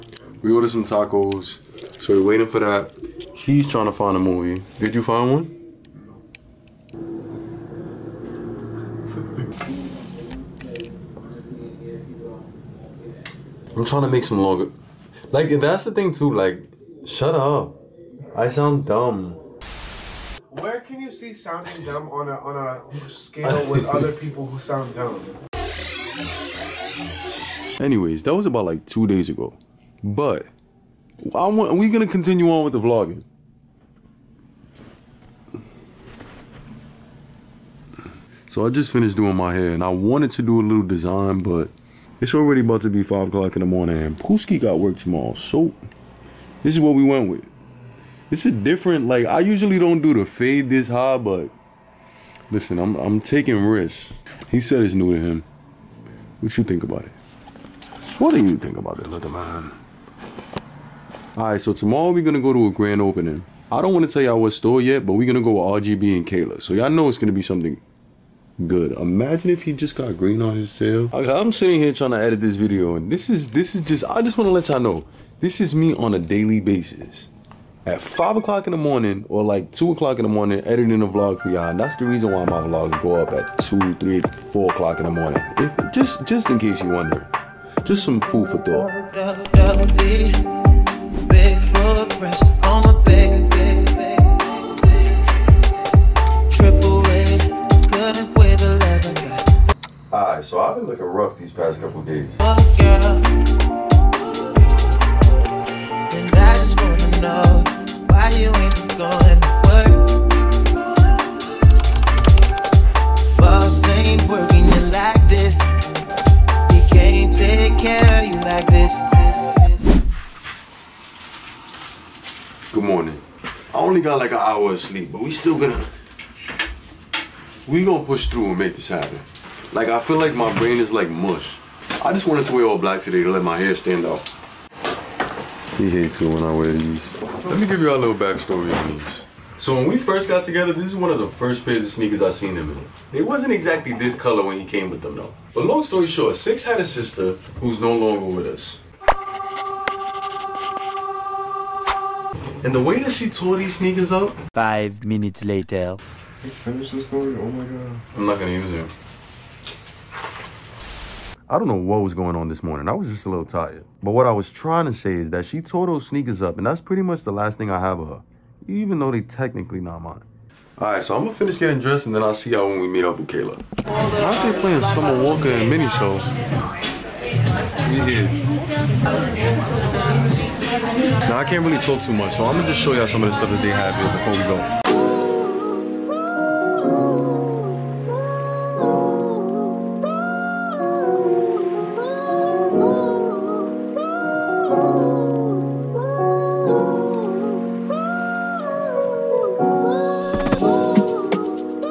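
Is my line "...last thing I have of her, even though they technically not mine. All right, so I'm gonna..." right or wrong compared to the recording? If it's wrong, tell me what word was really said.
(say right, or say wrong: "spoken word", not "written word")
right.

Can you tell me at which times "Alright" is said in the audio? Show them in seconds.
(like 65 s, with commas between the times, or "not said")
61 s, 100 s.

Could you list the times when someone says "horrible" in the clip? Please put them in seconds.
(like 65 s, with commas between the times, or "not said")
not said.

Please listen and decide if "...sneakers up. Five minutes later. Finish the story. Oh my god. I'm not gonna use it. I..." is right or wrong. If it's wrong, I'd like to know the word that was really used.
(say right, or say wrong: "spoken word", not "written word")
right.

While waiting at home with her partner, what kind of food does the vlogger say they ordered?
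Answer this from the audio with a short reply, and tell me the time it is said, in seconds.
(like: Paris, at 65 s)
Tacos, at 0 s.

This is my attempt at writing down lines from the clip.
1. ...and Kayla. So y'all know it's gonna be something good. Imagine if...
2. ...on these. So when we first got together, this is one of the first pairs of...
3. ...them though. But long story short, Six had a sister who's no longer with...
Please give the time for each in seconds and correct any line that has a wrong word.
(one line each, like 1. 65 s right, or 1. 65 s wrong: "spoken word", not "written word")
1. 66 s right
2. 138 s right
3. 145 s right.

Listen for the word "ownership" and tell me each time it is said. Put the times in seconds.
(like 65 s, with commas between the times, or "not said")
not said.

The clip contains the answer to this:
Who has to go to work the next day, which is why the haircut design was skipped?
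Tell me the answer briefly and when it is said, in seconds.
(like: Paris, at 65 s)
Pooski, at 44 s.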